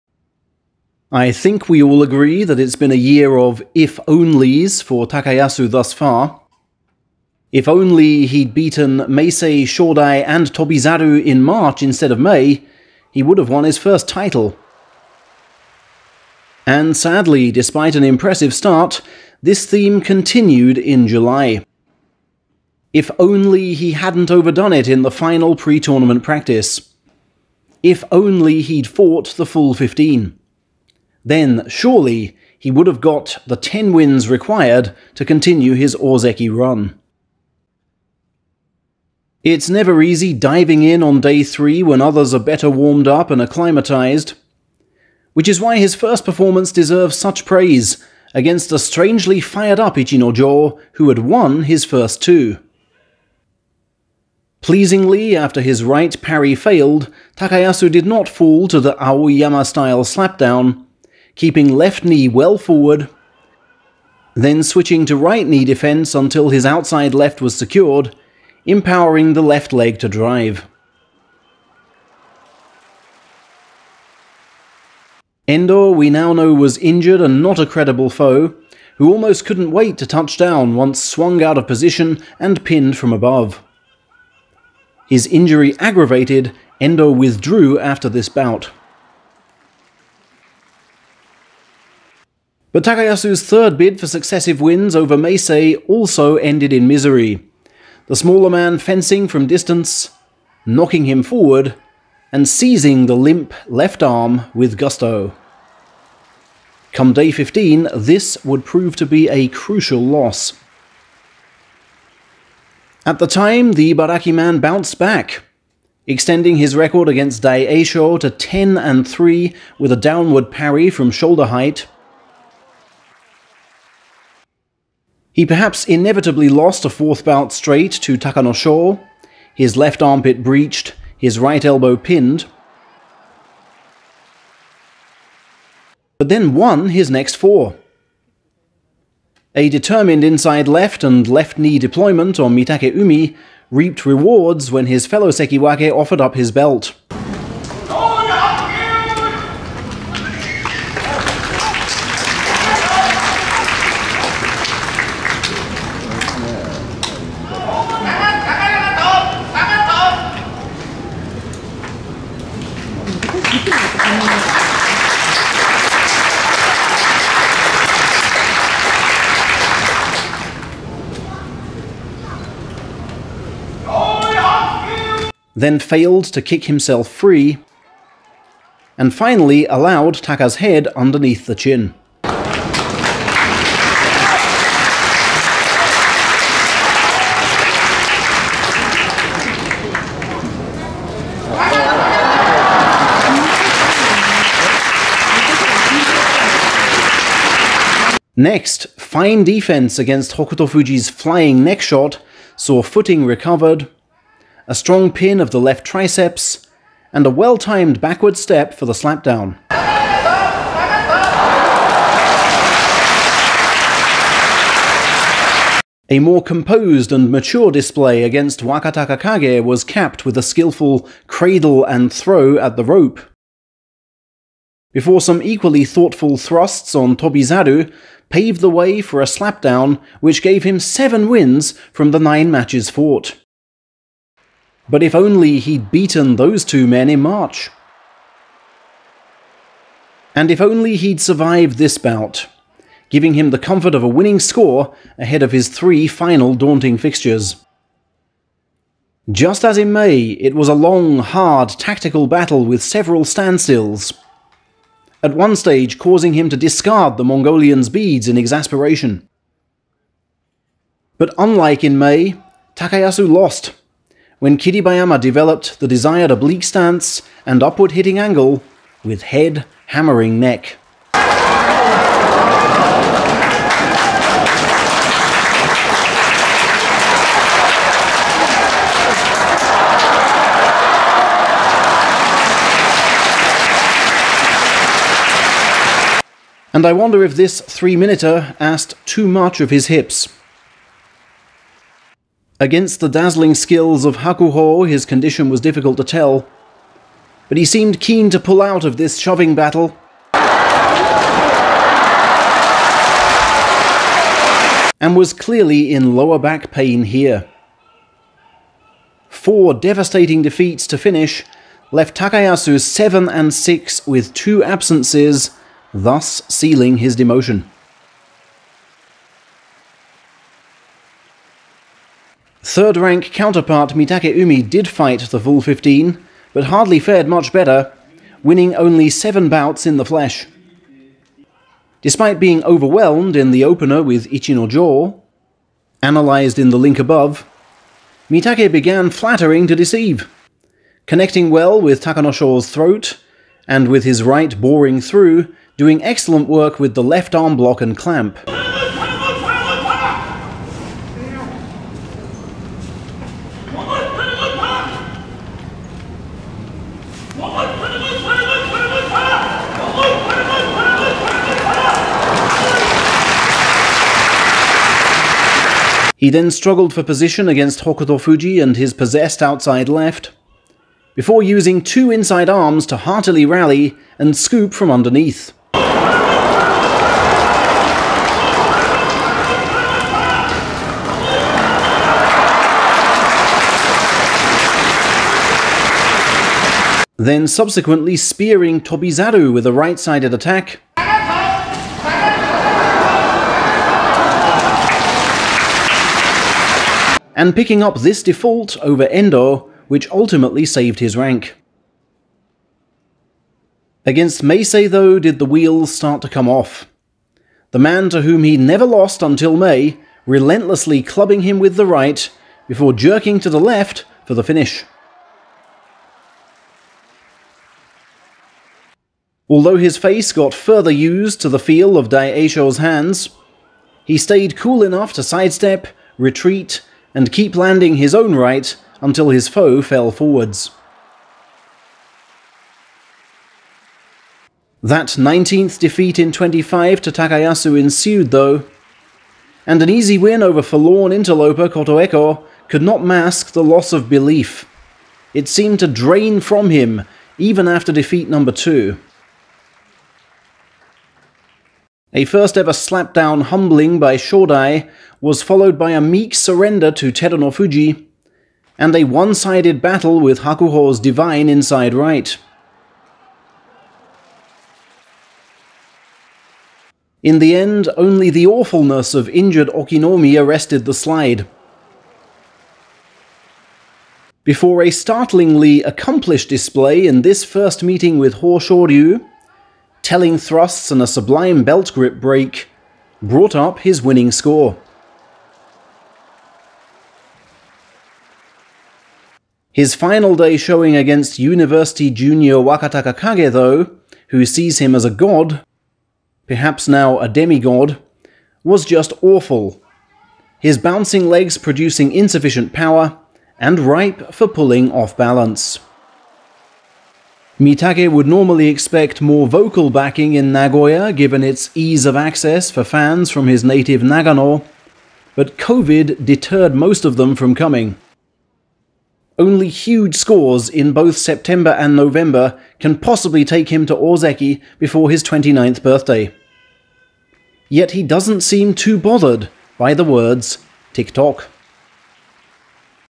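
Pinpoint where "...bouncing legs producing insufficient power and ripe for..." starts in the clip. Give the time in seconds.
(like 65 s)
500 s.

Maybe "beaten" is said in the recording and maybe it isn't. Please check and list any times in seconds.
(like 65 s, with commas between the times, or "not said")
8 s, 235 s.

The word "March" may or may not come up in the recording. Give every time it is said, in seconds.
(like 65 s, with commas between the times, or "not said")
11 s, 237 s.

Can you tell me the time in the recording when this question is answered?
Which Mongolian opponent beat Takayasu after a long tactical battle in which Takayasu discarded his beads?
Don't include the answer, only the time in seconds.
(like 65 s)
264 s.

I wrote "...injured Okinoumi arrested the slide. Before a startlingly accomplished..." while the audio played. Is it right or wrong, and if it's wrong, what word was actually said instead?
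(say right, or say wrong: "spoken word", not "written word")
right.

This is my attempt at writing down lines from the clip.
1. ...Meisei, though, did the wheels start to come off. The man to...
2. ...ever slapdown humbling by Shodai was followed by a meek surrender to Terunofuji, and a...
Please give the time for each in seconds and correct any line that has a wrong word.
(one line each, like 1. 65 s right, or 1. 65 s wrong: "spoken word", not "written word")
1. 404 s right
2. 452 s right.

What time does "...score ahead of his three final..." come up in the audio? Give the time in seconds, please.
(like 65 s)
244 s.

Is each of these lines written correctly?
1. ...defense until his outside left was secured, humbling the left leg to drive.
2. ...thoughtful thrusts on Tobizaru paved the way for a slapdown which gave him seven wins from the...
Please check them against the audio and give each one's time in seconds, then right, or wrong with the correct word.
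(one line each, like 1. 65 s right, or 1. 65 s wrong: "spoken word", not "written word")
1. 65 s wrong: "empowering", not "humbling"
2. 225 s right.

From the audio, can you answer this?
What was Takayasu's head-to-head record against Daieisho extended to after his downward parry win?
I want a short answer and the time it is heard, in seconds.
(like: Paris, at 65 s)
10 and 3, at 118 s.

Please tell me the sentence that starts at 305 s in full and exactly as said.
and was clearly in lower back pain here.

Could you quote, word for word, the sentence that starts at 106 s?
Come day 15, this would prove to be a crucial loss.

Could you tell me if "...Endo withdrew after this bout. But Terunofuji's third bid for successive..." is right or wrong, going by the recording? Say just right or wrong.
wrong.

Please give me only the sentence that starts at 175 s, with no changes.
then failed to kick himself free, and finally allowed Taka's head underneath the chin.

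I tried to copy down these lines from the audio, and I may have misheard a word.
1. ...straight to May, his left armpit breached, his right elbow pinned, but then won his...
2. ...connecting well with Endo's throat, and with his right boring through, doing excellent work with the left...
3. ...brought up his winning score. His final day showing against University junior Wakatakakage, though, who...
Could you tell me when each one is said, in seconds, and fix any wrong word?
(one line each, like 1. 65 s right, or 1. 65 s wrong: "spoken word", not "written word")
1. 127 s wrong: "Takanosho", not "May"
2. 341 s wrong: "Takanosho", not "Endo"
3. 483 s right.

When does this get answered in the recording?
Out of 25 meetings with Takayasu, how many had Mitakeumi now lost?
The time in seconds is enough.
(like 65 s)
435 s.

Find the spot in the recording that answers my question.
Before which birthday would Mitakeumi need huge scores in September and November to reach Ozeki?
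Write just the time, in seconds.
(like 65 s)
525 s.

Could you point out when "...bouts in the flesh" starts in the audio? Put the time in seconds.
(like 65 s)
329 s.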